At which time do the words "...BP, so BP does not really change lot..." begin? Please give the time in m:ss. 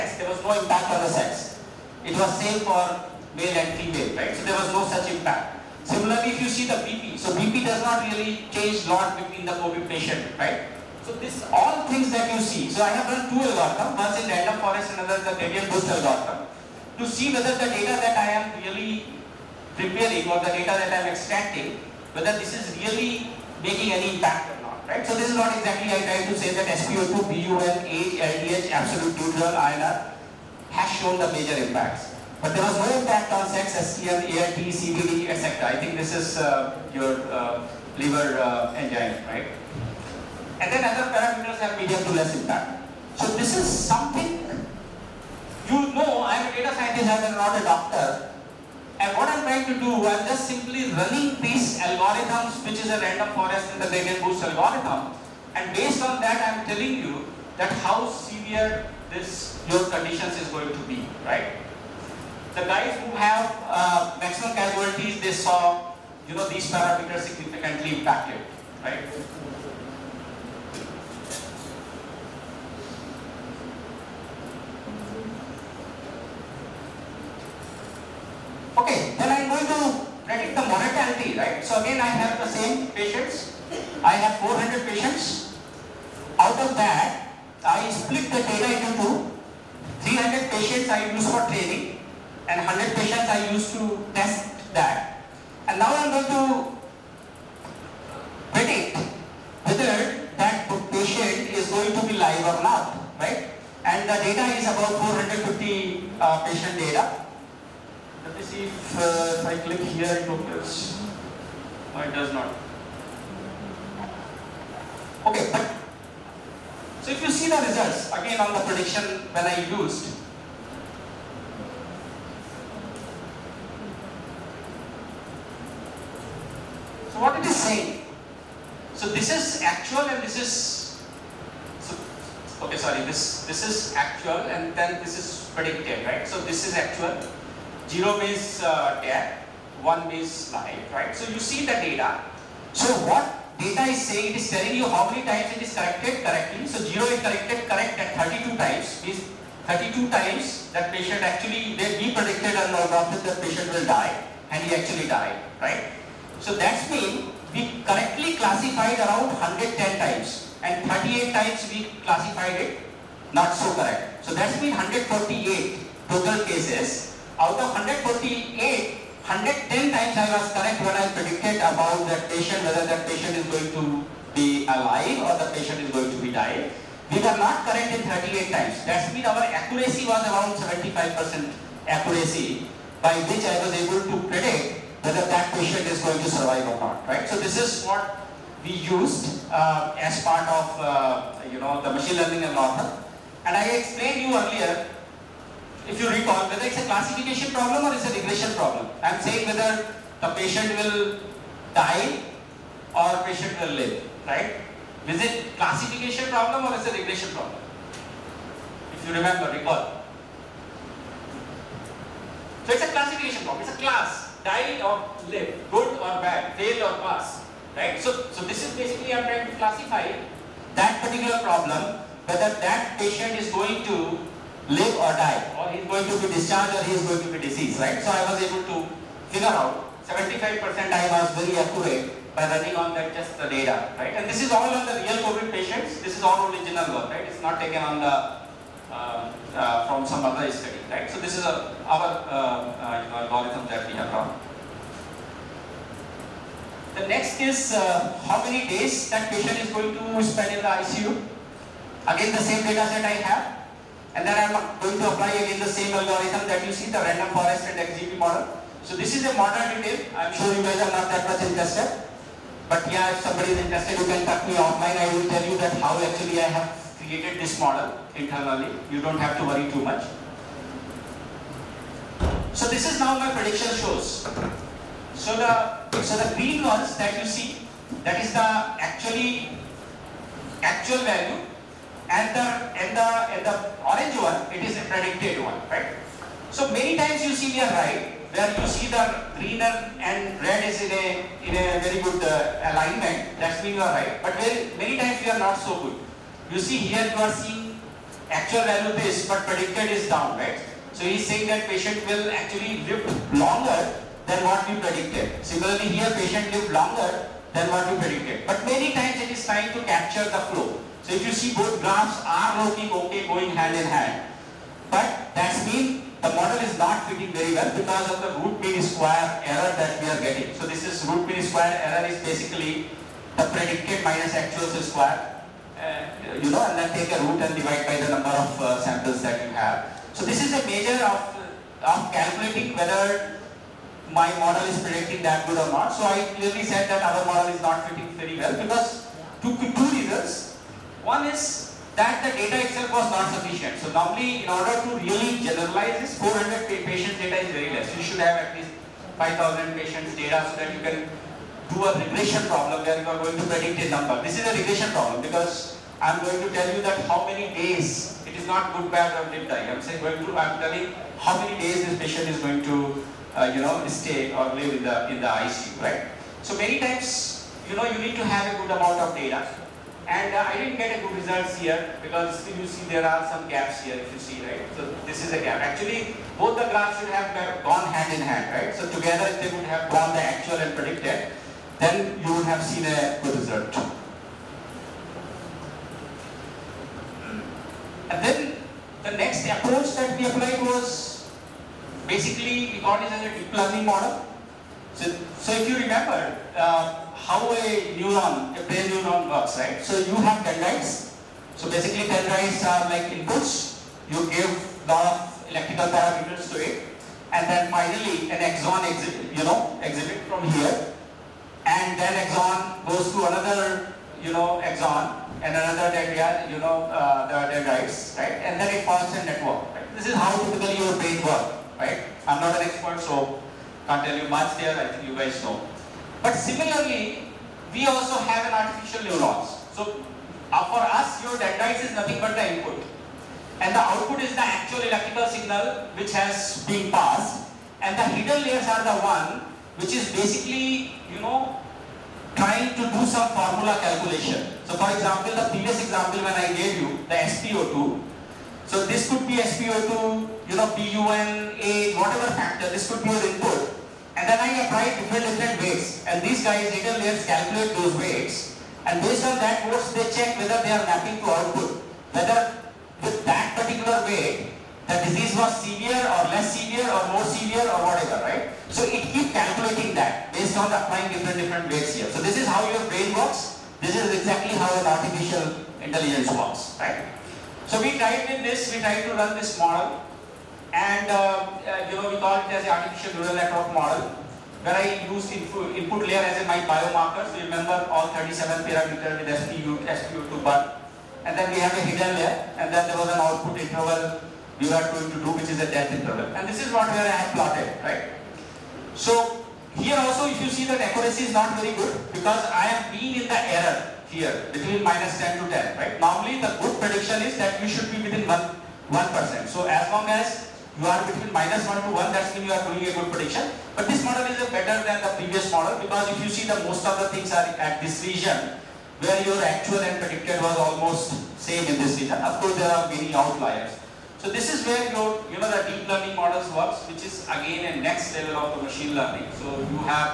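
0:06.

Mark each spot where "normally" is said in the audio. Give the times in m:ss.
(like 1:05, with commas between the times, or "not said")
5:43, 8:26.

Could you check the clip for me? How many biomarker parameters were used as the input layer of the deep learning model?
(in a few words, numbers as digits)
37.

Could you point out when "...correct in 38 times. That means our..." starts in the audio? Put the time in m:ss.
2:57.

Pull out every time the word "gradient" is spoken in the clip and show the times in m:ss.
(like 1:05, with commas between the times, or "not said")
0:15, 0:53.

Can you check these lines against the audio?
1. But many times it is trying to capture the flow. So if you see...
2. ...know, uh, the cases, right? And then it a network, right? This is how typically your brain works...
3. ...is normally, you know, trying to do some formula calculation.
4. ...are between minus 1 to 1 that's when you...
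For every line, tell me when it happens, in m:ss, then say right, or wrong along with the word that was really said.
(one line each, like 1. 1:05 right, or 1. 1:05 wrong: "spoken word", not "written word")
1. 5:08 right
2. 6:56 wrong: "dendrites", not "cases"
3. 7:19 wrong: "basically", not "normally"
4. 8:30 right.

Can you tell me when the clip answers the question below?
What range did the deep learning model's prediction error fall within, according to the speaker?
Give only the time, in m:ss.
8:24.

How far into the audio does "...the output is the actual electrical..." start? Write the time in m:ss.
7:13.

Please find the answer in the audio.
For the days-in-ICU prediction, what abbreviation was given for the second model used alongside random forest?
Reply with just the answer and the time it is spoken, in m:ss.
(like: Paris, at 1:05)
XGB, at 4:17.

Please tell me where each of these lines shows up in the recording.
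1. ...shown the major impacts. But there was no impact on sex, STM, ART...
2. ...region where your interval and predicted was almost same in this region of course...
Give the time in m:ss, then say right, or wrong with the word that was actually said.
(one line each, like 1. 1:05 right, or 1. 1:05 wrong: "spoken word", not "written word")
1. 0:31 right
2. 8:38 wrong: "actual", not "interval".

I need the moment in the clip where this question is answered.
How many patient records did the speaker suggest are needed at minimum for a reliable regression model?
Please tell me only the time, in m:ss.
5:49.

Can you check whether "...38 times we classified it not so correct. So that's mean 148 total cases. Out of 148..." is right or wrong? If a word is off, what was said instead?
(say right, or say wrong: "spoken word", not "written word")
right.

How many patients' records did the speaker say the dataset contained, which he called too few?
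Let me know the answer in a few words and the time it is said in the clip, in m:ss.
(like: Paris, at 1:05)
400, at 5:46.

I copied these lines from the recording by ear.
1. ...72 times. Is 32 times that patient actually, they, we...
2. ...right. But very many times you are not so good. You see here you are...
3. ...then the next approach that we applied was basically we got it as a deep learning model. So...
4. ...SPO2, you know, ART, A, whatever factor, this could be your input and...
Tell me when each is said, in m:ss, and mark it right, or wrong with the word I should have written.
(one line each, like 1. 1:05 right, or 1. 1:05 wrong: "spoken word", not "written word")
1. 2:28 wrong: "32", not "72"
2. 4:53 right
3. 6:28 right
4. 7:29 wrong: "BUN", not "ART".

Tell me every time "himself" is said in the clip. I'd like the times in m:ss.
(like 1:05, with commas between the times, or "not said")
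not said.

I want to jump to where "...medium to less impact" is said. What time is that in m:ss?
0:41.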